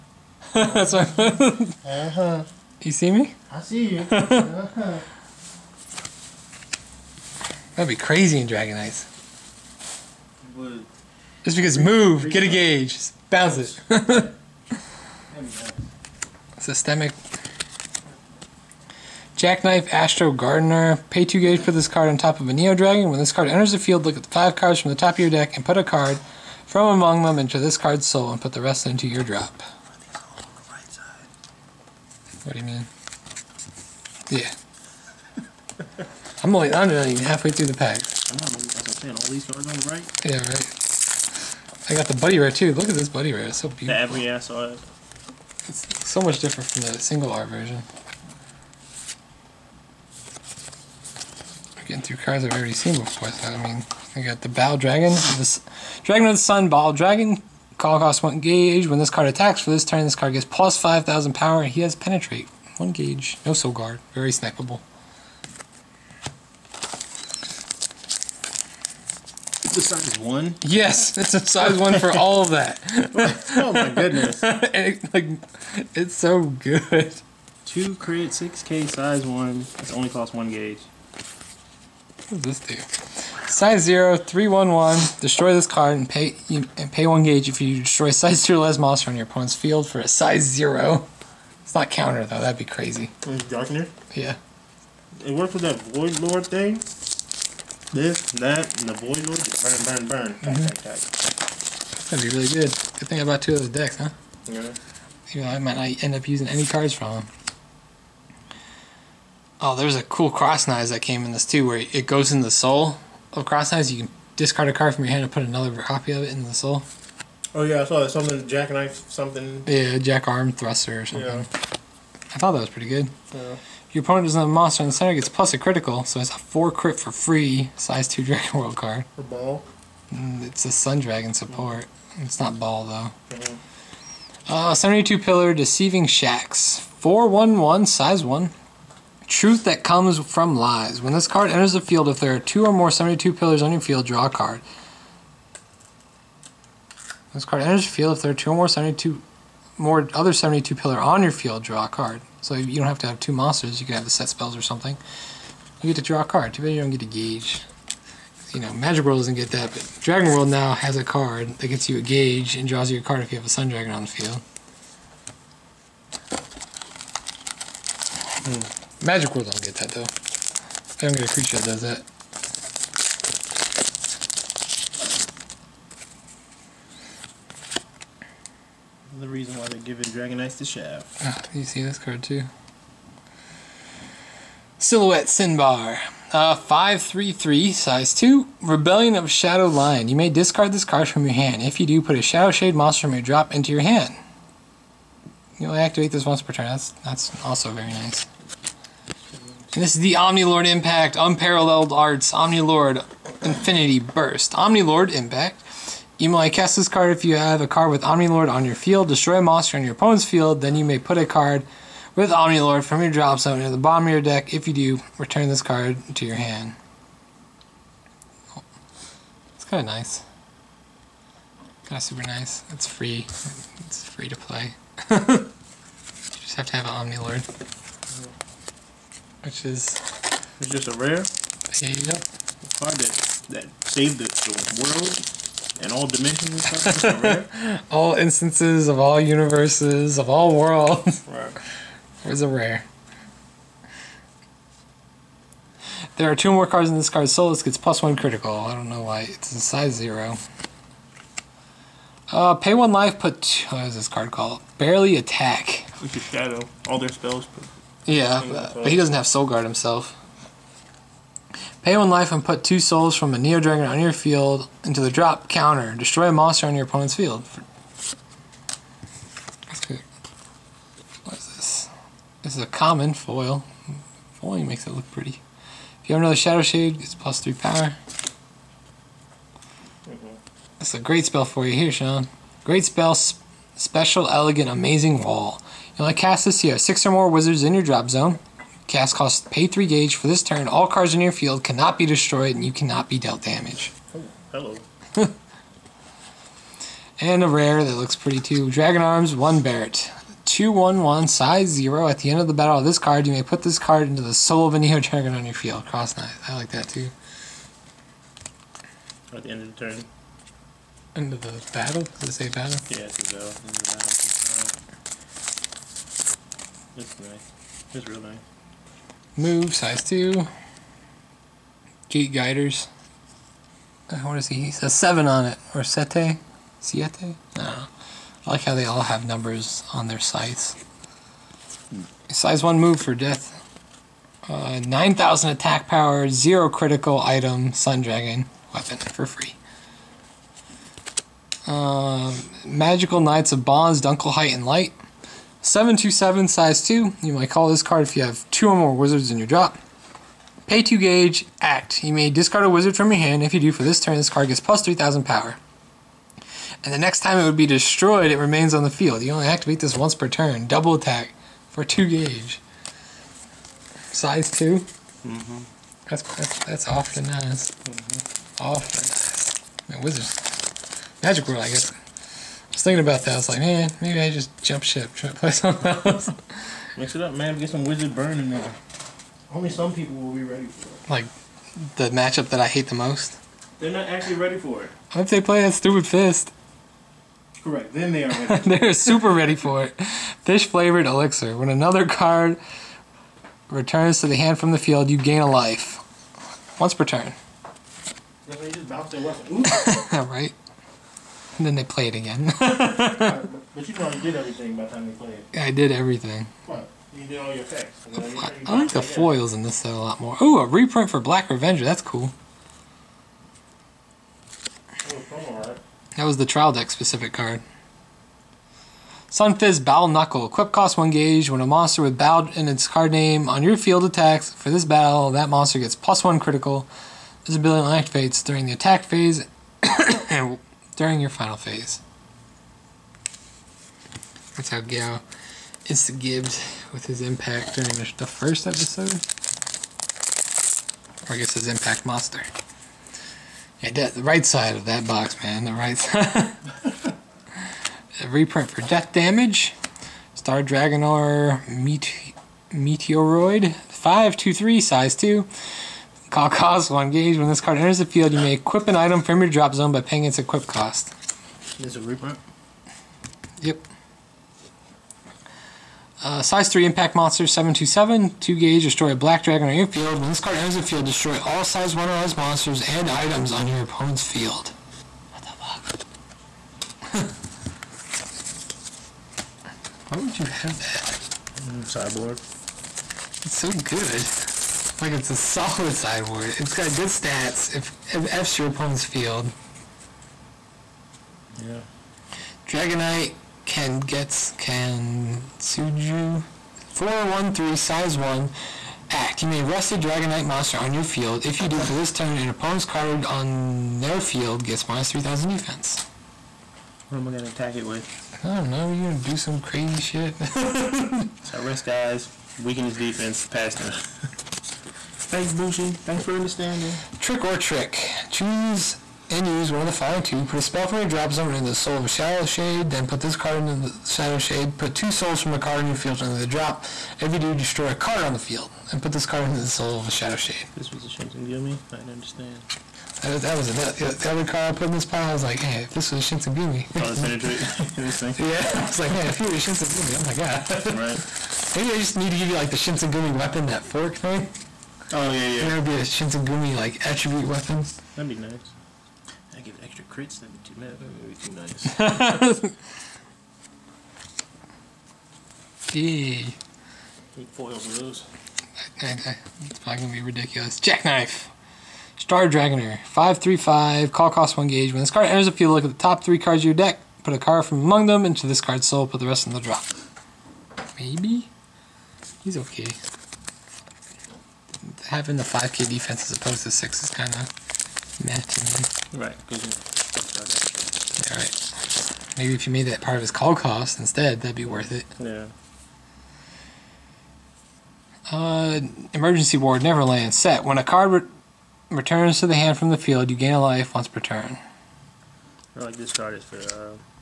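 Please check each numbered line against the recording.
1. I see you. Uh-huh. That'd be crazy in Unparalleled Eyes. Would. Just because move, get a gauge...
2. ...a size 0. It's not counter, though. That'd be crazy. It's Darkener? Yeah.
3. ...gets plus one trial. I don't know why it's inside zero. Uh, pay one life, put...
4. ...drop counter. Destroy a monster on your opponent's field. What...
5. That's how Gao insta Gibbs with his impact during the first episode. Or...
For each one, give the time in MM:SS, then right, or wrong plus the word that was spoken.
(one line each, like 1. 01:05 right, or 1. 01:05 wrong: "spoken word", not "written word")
1. 00:03 wrong: "Dragon", not "Unparalleled"
2. 01:30 right
3. 04:07 wrong: "critical", not "trial"
4. 04:25 right
5. 07:14 right.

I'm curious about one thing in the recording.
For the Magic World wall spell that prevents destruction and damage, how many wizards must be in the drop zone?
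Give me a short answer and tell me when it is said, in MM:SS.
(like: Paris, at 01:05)
6, at 04:46.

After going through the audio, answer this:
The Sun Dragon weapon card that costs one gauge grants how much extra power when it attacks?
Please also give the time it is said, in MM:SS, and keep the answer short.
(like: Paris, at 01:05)
5,000, at 01:00.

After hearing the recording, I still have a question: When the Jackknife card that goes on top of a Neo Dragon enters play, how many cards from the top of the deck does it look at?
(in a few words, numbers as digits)
5.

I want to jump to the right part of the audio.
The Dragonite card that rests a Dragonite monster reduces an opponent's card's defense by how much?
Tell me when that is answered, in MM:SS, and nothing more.
08:25.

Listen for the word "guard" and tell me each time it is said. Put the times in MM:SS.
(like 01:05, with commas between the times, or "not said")
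01:03, 04:19.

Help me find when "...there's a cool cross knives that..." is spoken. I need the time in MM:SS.
01:49.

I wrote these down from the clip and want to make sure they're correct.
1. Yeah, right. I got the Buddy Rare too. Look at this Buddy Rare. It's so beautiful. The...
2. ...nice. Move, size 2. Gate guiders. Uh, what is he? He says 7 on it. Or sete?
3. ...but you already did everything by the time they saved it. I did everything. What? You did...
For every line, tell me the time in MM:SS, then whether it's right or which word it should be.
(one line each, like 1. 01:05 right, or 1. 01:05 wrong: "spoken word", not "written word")
1. 00:40 right
2. 05:18 right
3. 06:42 wrong: "played", not "saved".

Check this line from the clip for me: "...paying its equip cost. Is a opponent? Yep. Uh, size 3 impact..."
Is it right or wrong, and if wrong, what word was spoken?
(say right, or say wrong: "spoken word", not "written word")
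wrong: "reprint", not "opponent".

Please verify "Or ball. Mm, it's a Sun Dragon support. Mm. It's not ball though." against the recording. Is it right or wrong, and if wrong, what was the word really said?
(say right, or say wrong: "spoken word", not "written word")
right.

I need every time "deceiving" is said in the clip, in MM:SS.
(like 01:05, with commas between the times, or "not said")
02:15.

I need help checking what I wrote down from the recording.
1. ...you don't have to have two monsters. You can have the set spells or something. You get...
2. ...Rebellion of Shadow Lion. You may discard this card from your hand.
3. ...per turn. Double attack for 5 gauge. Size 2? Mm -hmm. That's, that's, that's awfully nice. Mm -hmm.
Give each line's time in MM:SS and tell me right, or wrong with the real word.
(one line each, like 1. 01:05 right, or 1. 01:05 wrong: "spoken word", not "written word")
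1. 02:32 right
2. 03:08 right
3. 06:00 wrong: "2", not "5".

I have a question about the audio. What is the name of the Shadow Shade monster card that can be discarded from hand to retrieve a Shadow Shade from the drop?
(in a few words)
Silhouette Sinbar.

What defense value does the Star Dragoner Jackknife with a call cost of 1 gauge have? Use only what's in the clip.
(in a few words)
5k.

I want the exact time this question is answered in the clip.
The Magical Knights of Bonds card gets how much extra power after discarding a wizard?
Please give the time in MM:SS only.
05:54.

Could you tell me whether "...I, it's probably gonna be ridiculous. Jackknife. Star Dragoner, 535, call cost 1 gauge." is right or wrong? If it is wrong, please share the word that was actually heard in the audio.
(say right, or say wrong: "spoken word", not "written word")
right.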